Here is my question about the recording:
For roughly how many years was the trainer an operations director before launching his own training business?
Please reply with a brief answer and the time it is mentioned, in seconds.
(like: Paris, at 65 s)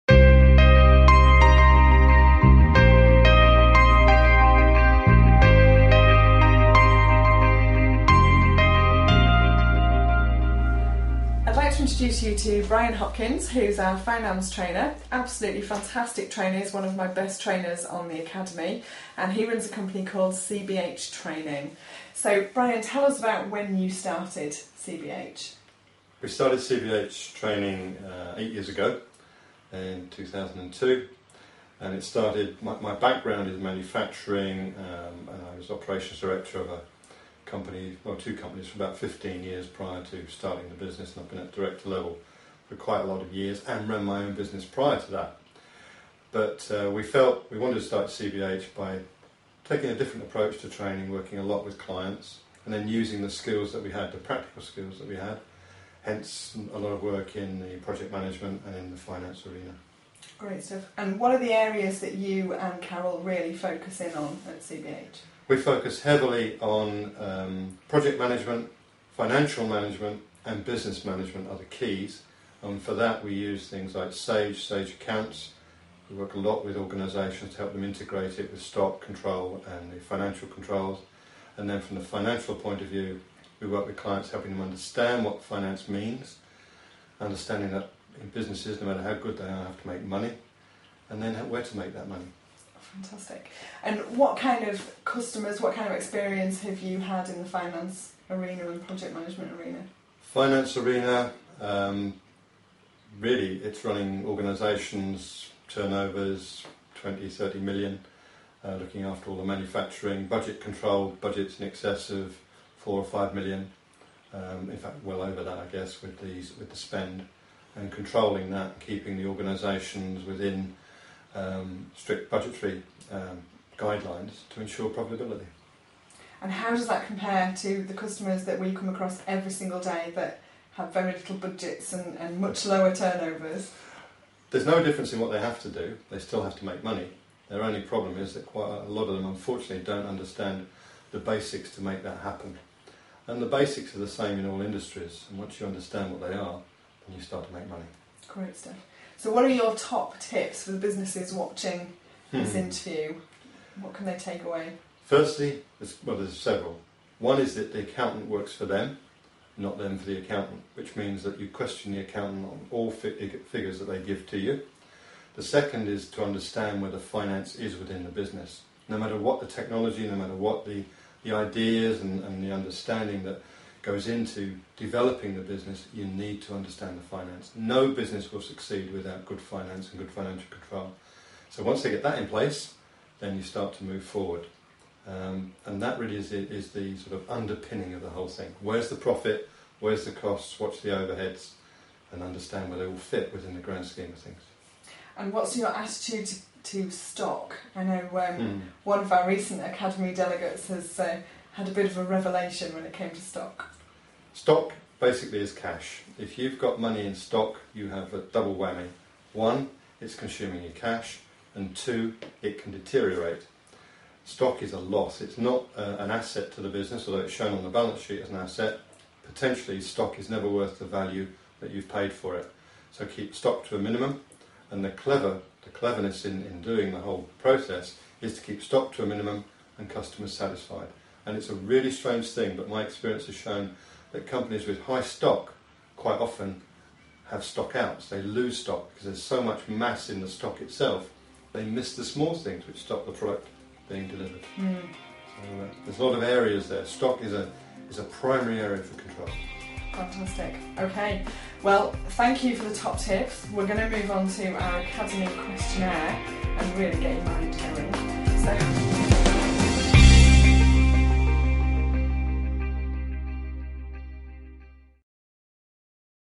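15 years, at 38 s.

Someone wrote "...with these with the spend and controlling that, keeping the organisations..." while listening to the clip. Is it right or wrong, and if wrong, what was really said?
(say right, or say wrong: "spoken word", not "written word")
right.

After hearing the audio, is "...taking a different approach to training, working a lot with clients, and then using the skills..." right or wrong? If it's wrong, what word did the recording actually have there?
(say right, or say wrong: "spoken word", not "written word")
right.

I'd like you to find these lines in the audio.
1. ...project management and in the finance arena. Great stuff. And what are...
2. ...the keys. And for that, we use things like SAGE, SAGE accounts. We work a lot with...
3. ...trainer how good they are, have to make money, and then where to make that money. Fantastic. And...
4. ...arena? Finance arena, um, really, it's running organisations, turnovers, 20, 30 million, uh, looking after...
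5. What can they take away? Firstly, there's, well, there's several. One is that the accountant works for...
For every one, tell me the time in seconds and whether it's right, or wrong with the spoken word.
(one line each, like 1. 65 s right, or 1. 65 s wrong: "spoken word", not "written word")
1. 57 s right
2. 71 s right
3. 88 s wrong: "matter", not "trainer"
4. 99 s right
5. 153 s right.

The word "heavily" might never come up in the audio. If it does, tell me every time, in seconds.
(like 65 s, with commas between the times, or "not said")
66 s.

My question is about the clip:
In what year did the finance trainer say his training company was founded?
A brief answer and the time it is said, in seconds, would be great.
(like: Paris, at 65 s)
2002, at 30 s.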